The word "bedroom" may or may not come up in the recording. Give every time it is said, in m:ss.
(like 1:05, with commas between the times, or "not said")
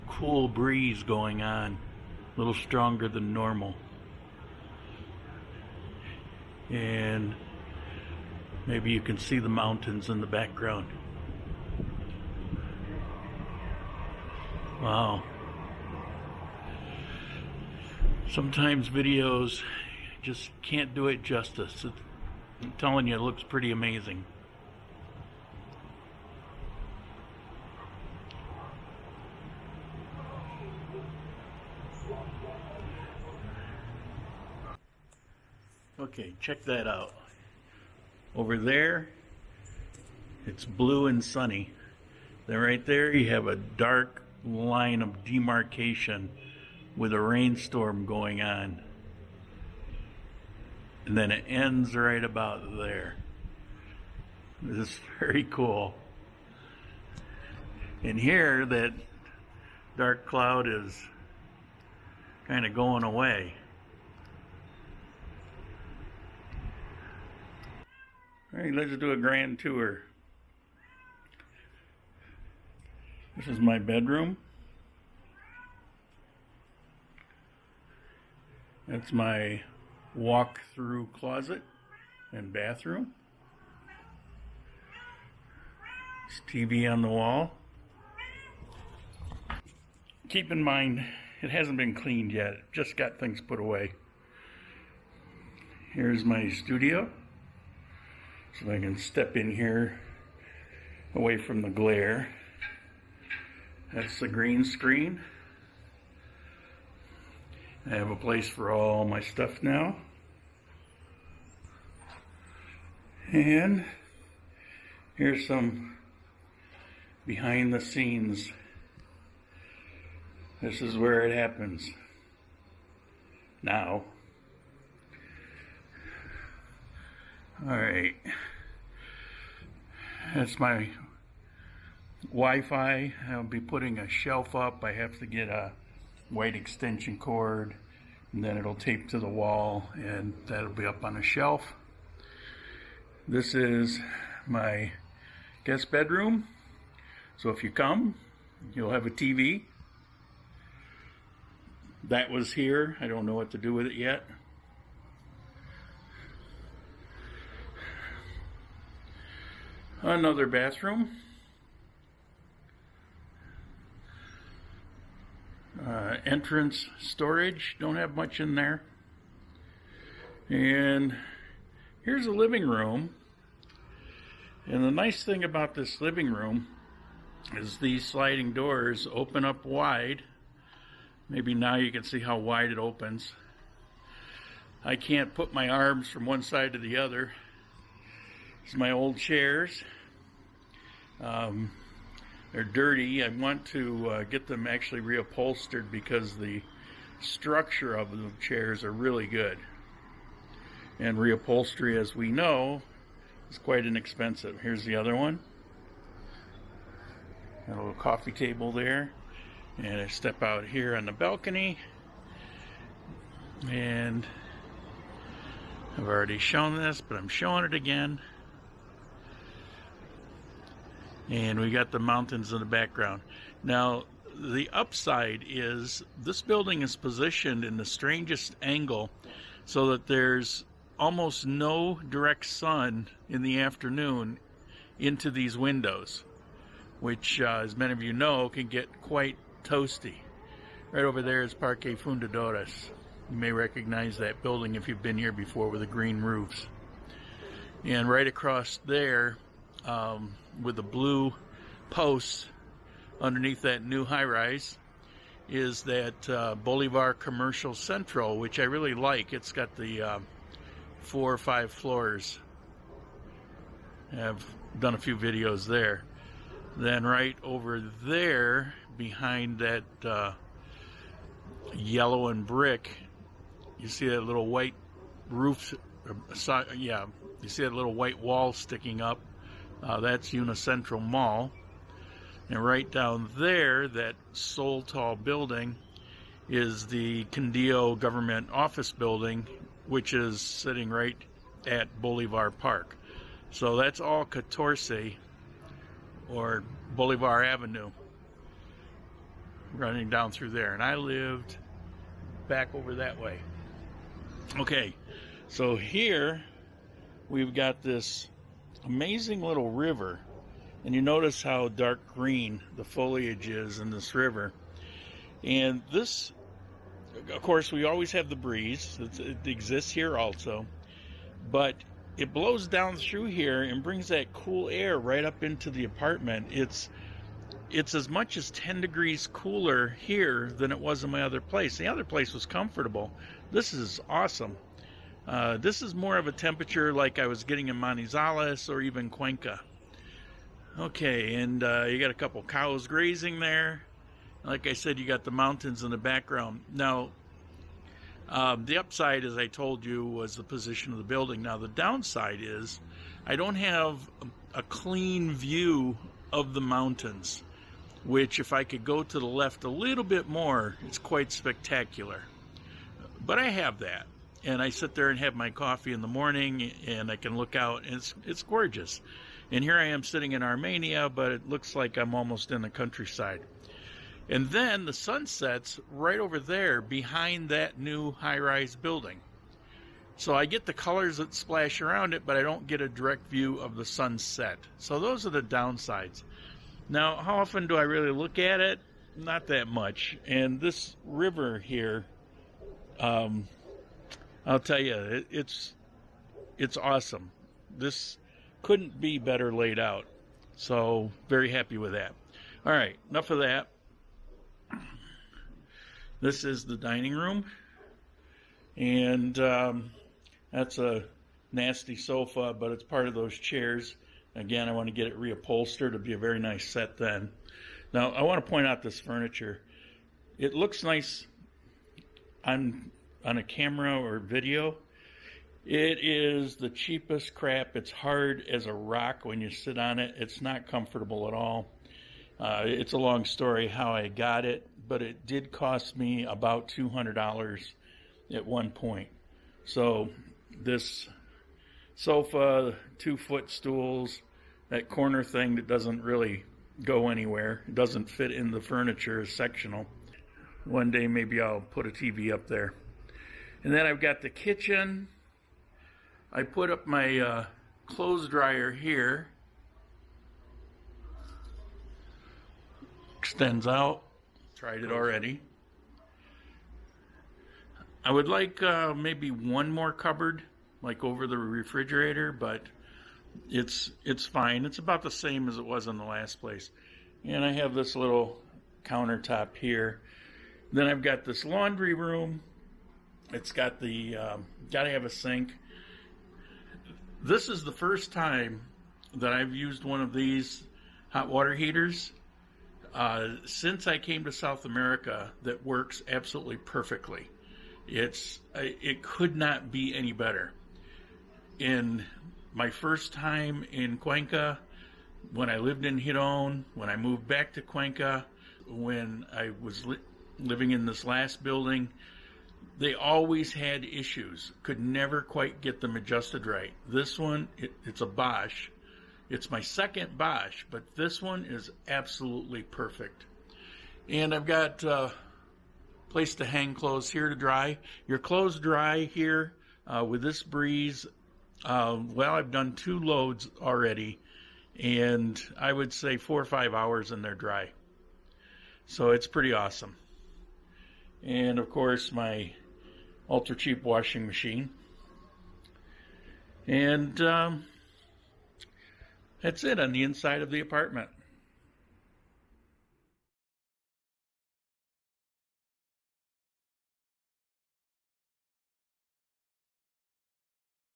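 1:13, 2:25.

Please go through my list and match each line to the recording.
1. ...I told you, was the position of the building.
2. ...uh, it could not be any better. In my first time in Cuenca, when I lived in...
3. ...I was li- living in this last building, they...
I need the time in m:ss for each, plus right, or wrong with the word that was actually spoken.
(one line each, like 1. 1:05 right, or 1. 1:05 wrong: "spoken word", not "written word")
1. 5:49 right
2. 8:18 right
3. 8:29 right.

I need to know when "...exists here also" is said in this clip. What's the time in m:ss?
5:19.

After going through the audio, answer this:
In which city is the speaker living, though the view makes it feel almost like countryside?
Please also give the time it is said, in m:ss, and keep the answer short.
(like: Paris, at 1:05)
Armenia, at 6:10.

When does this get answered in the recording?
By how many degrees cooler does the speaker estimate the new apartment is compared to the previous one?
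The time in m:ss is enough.
5:28.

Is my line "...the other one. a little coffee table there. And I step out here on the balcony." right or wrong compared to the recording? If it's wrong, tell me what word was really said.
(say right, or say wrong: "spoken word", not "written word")
right.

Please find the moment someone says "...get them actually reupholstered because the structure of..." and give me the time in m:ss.
3:14.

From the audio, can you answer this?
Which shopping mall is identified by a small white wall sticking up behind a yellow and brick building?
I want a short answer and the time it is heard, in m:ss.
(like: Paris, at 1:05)
Unicentro Mall, at 4:40.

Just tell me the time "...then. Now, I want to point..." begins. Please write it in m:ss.
6:56.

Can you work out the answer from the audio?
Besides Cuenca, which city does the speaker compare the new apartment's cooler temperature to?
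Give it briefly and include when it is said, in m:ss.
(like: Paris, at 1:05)
Manizales, at 5:37.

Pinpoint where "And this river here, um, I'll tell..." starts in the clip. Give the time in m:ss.
6:30.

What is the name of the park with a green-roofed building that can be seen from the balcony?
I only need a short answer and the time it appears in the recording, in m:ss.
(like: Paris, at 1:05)
Parque Fundadores, at 4:01.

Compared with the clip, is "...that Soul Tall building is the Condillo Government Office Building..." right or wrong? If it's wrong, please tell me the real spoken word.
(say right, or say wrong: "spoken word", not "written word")
right.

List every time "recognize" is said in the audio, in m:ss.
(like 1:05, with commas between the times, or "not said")
4:03.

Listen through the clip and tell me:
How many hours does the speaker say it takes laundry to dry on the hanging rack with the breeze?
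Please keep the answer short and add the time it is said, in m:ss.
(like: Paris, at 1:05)
4 or 5, at 8:56.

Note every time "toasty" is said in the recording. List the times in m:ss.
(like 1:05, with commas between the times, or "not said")
3:59.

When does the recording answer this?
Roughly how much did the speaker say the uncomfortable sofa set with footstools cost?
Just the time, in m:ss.
7:16.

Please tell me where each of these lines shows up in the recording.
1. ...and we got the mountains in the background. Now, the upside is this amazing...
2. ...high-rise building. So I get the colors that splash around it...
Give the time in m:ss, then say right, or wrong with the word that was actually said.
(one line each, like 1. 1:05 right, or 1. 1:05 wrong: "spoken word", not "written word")
1. 3:41 wrong: "building", not "amazing"
2. 6:18 right.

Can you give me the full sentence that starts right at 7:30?
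One day maybe I'll put a TV up there.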